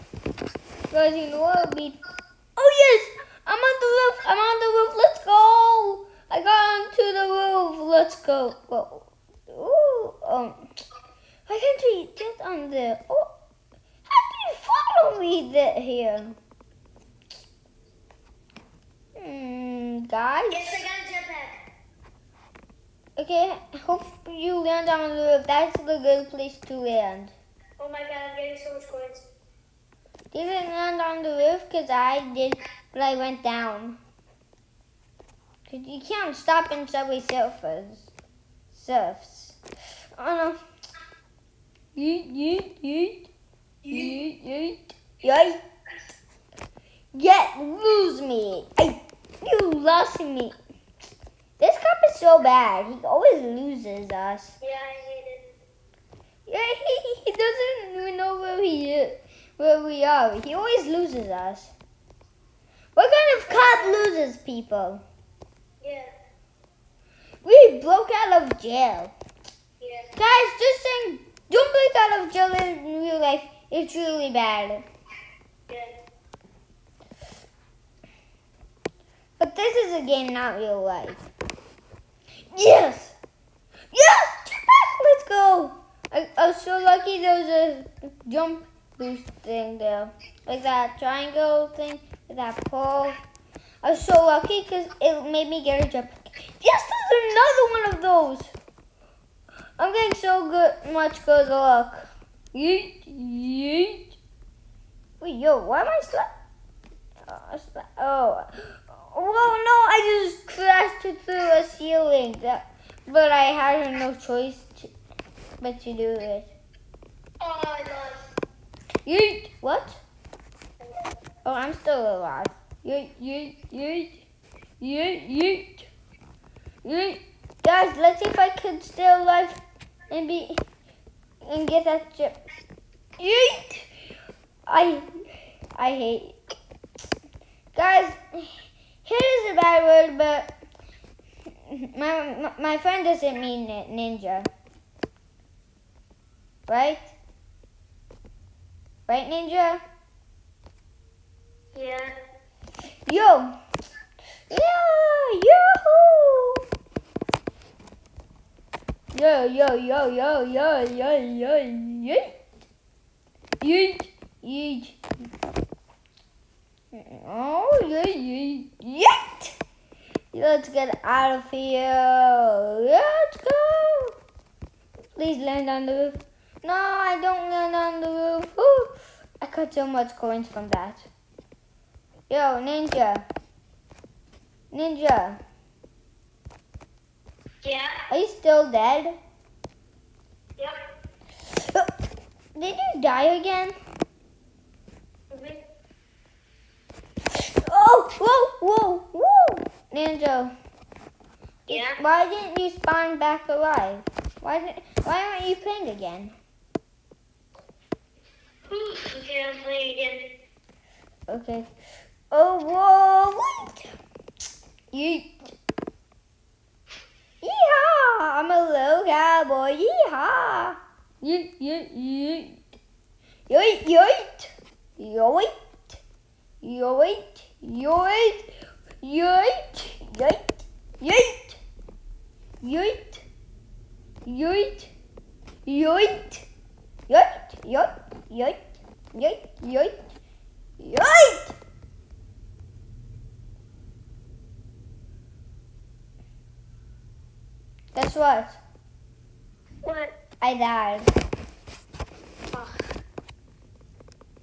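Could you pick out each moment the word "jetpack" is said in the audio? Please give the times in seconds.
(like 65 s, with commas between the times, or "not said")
21 s.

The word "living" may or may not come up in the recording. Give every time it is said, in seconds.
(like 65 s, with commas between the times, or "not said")
not said.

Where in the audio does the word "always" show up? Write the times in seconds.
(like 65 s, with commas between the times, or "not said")
53 s, 60 s.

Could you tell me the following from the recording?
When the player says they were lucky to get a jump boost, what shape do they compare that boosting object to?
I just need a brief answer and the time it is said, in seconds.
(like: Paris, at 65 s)
Triangle, at 90 s.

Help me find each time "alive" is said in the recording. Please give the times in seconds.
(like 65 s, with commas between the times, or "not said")
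122 s, 129 s, 203 s.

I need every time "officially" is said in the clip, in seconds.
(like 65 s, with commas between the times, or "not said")
not said.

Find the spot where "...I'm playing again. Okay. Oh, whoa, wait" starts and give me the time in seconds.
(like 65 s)
209 s.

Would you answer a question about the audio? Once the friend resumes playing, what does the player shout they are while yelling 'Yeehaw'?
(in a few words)
A little cowboy.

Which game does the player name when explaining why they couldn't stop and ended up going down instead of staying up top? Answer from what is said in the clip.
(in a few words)
Subway Surfers.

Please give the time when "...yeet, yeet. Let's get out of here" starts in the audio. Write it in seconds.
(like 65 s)
167 s.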